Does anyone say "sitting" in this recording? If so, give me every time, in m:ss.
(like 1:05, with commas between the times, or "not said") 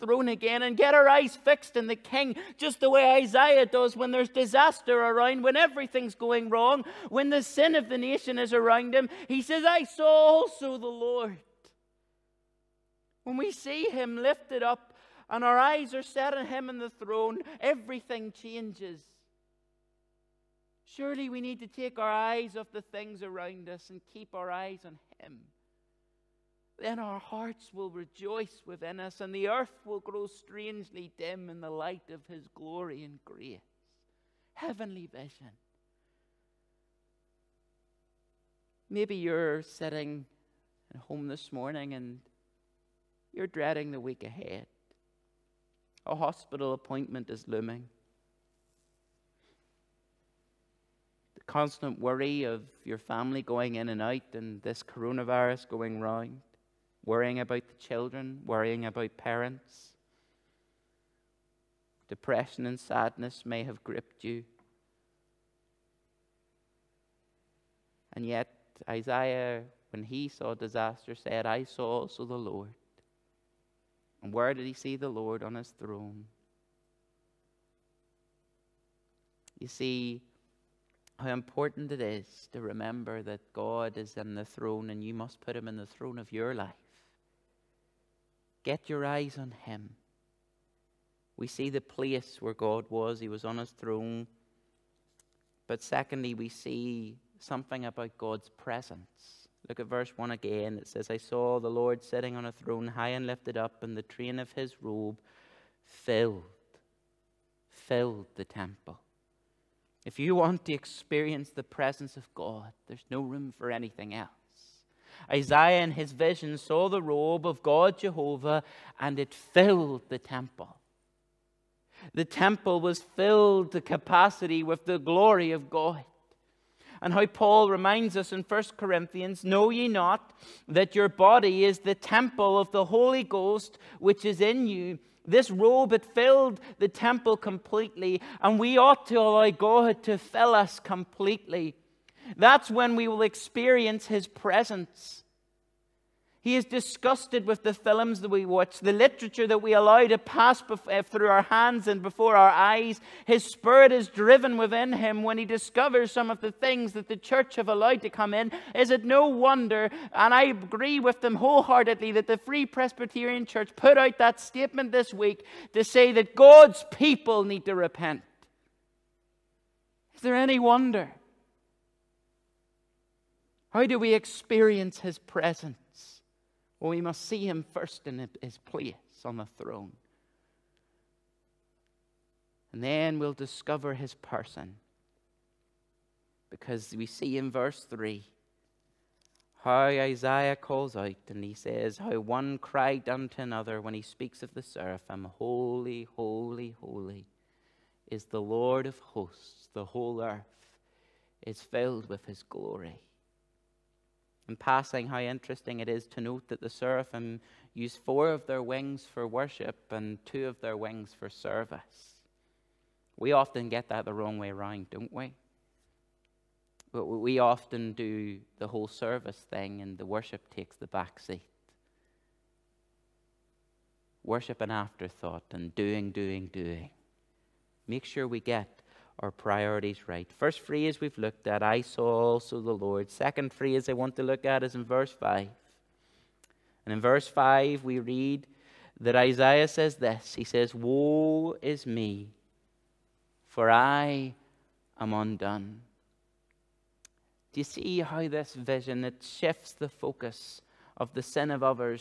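0:39, 1:42.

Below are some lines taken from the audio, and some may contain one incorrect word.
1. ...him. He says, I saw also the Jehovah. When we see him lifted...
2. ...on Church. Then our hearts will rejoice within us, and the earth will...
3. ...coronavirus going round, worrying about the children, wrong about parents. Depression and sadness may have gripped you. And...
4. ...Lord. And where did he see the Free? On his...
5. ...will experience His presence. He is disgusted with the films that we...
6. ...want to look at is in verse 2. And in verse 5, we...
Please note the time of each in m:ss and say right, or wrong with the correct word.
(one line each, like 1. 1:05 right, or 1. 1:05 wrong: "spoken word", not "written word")
1. 0:08 wrong: "Lord", not "Jehovah"
2. 0:24 wrong: "Him", not "Church"
3. 0:54 wrong: "worrying", not "wrong"
4. 1:12 wrong: "Lord", not "Free"
5. 2:23 right
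6. 3:53 wrong: "5", not "2".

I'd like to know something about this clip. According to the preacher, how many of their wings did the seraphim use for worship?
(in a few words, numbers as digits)
4.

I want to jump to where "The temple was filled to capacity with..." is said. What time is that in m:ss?
2:02.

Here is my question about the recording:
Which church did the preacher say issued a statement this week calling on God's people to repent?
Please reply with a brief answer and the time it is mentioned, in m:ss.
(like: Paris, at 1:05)
Free Presbyterian Church, at 2:42.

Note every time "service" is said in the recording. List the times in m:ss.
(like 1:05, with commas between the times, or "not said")
3:31, 3:38.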